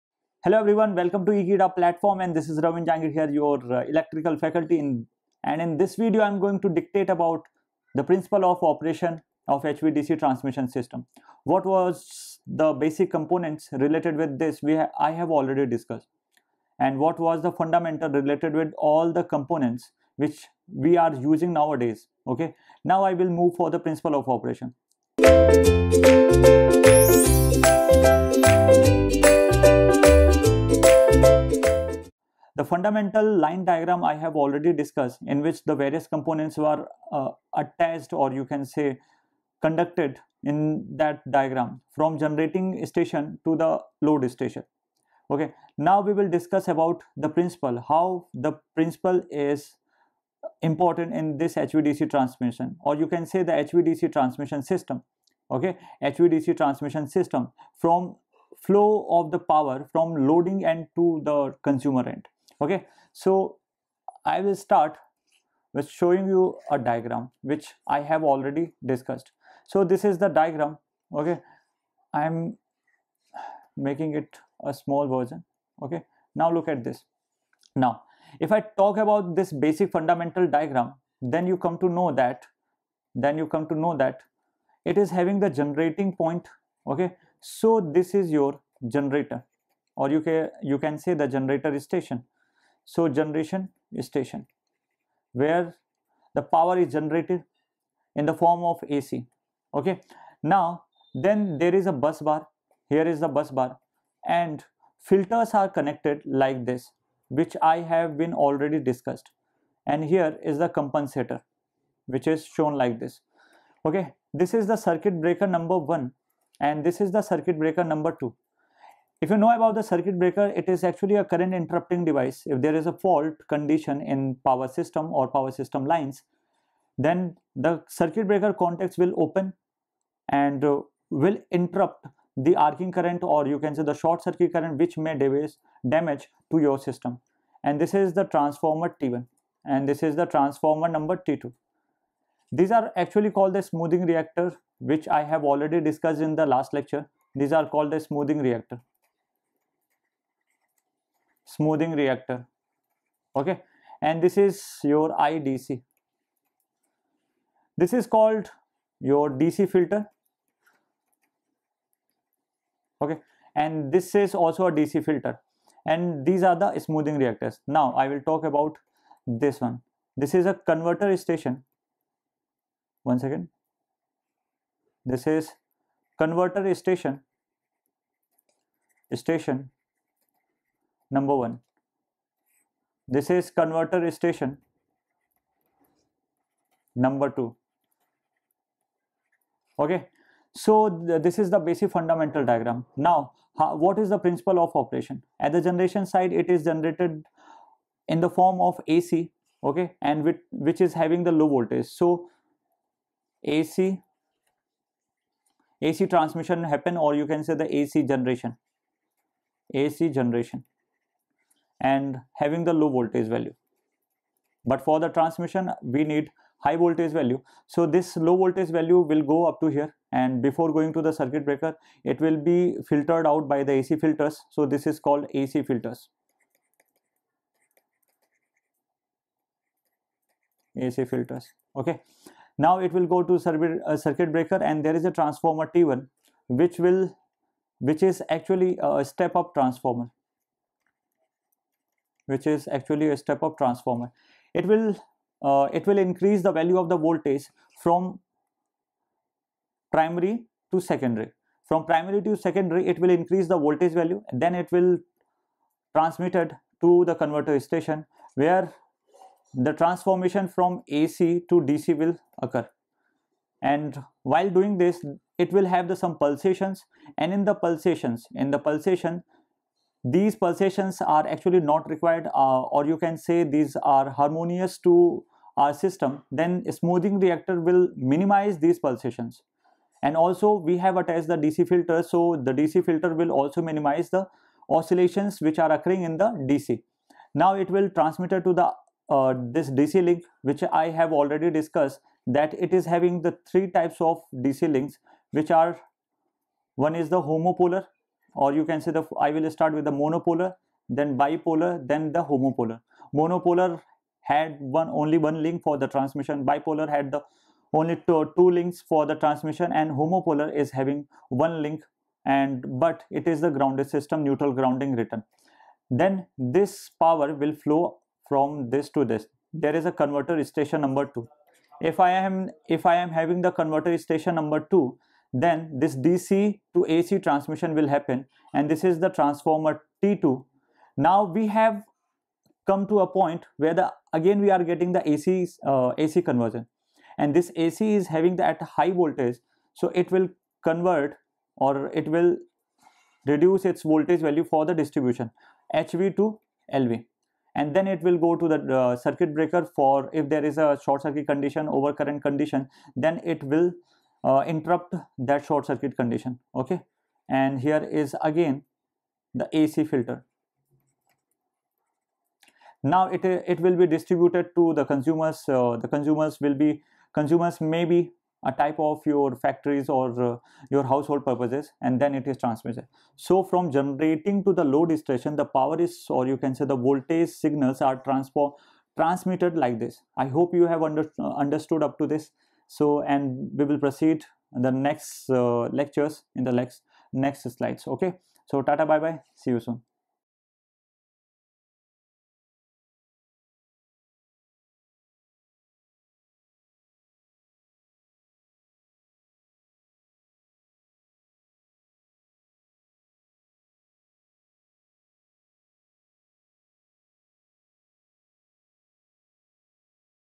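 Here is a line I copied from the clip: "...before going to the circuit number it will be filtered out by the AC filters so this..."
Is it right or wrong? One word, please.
wrong.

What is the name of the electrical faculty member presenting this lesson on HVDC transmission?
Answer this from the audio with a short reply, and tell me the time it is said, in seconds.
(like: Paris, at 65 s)
Ravin Jangid, at 2 s.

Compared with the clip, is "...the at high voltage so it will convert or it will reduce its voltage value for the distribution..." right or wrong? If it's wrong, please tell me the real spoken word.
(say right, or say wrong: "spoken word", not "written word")
right.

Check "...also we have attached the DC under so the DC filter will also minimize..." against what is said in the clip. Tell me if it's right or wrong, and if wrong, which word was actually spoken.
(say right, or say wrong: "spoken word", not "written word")
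wrong: "filter", not "under".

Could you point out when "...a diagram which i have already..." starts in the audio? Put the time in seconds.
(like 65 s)
66 s.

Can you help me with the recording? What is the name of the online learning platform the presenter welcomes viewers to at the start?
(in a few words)
Ekeeda.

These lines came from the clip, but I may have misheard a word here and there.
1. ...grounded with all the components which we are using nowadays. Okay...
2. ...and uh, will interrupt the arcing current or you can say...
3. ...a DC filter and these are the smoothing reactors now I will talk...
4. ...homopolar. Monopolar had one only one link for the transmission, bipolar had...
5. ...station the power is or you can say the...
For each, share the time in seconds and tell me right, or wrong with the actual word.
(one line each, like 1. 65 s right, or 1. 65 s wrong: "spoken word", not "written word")
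1. 18 s wrong: "related", not "grounded"
2. 130 s right
3. 164 s right
4. 302 s right
5. 374 s right.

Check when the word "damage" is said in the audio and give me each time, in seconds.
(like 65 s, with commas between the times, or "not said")
135 s.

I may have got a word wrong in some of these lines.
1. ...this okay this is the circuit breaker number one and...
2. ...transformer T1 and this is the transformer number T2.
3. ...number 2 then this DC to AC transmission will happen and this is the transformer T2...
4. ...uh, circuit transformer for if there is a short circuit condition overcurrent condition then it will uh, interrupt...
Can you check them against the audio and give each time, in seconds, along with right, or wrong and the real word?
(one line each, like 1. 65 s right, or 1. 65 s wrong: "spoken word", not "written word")
1. 112 s right
2. 138 s right
3. 324 s right
4. 348 s wrong: "breaker", not "transformer".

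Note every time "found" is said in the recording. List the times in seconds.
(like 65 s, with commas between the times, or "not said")
not said.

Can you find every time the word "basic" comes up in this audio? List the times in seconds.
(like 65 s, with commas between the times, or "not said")
12 s, 79 s, 191 s.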